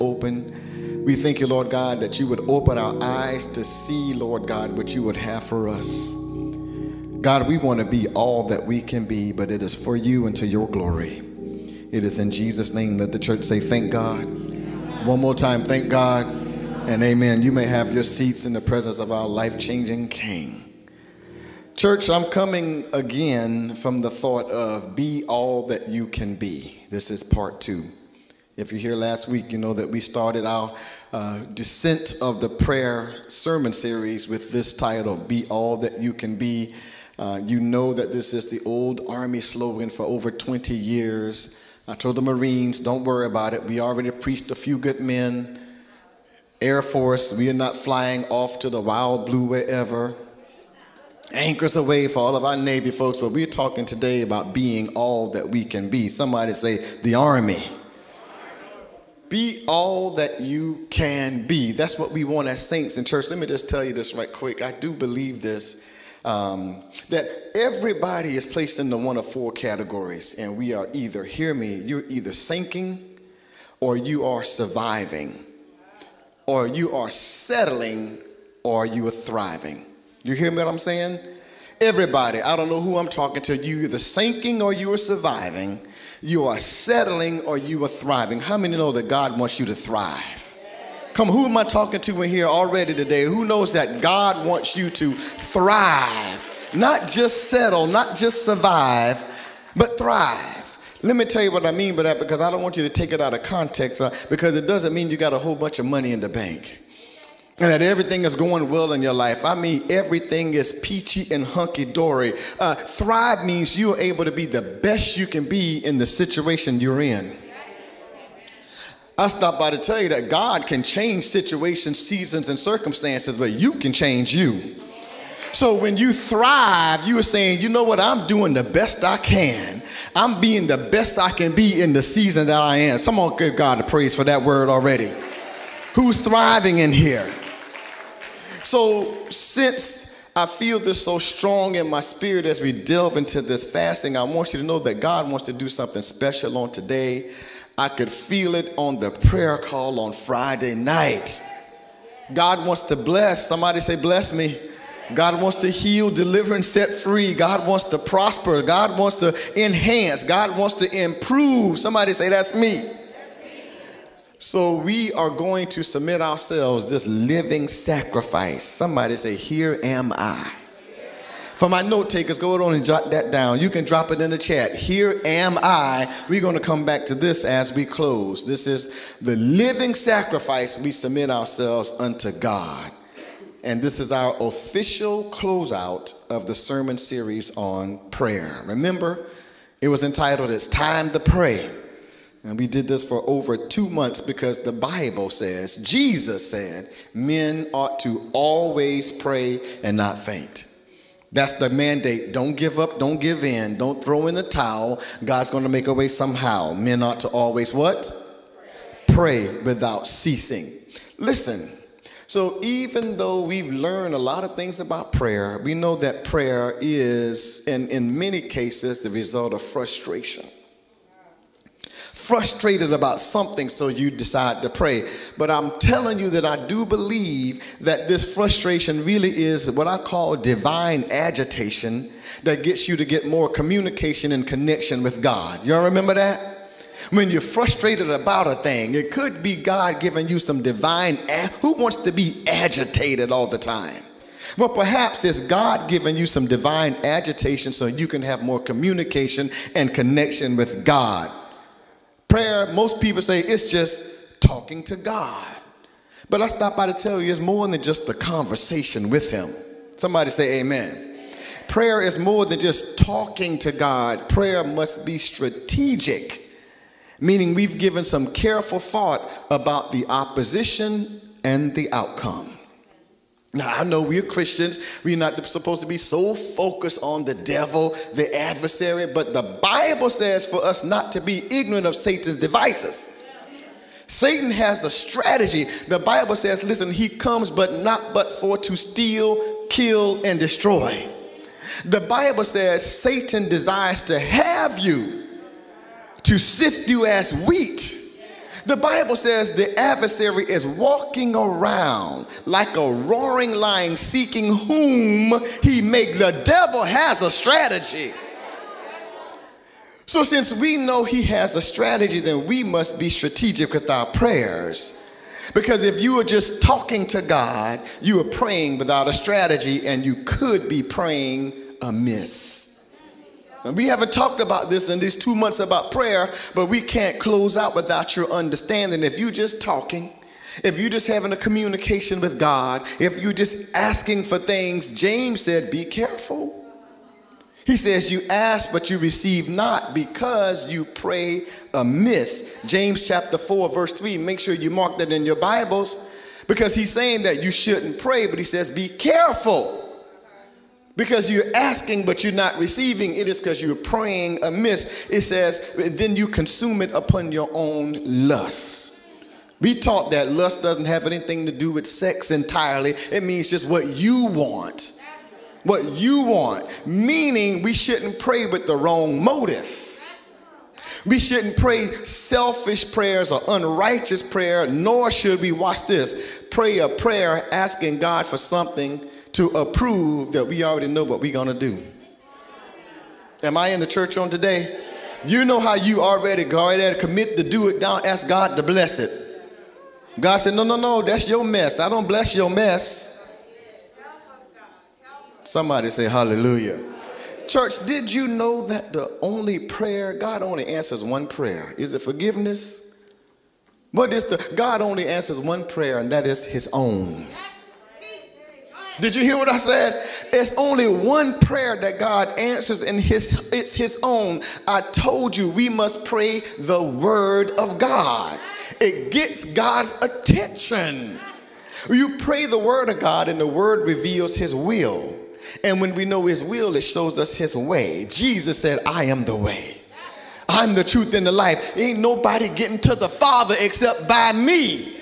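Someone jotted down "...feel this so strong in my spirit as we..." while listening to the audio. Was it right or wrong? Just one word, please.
right.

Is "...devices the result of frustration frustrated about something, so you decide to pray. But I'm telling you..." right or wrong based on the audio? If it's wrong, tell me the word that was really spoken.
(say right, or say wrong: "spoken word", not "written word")
wrong: "cases", not "devices".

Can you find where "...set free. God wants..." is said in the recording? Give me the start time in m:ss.
2:36.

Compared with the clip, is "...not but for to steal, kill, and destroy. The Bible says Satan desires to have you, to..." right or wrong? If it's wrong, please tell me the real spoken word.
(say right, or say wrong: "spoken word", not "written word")
right.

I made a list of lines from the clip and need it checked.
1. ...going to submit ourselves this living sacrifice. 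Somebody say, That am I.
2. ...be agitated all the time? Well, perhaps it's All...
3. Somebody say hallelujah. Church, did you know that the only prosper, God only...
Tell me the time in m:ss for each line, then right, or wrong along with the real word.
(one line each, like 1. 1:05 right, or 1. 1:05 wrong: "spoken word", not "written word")
1. 2:45 wrong: "Here", not "That"
2. 4:02 wrong: "God", not "All"
3. 6:35 wrong: "prayer", not "prosper".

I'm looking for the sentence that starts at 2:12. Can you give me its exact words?
Someone give God the praise for that word already.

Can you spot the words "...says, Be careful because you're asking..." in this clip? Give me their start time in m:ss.
5:48.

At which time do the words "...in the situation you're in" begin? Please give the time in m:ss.
1:55.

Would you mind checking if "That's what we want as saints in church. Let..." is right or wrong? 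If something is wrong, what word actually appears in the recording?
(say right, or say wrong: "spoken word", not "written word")
right.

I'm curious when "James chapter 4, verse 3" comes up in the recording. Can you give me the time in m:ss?
5:42.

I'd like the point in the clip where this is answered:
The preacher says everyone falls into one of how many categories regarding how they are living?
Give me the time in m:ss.
1:09.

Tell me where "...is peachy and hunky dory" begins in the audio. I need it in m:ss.
1:50.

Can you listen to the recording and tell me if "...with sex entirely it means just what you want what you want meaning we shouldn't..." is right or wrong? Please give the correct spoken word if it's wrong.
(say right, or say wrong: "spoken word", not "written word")
right.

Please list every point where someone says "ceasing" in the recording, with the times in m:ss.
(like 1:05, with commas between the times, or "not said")
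3:30.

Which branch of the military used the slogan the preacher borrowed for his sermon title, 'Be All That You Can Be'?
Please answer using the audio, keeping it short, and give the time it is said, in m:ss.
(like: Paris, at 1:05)
The Army, at 0:57.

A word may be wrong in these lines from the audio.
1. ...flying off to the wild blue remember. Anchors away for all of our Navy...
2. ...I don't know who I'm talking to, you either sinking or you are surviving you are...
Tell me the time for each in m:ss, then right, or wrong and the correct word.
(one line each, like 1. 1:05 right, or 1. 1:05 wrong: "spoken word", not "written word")
1. 0:47 wrong: "wherever", not "remember"
2. 1:22 right.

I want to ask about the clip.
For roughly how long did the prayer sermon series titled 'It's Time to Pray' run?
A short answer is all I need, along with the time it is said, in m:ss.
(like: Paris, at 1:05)
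Over two months, at 3:13.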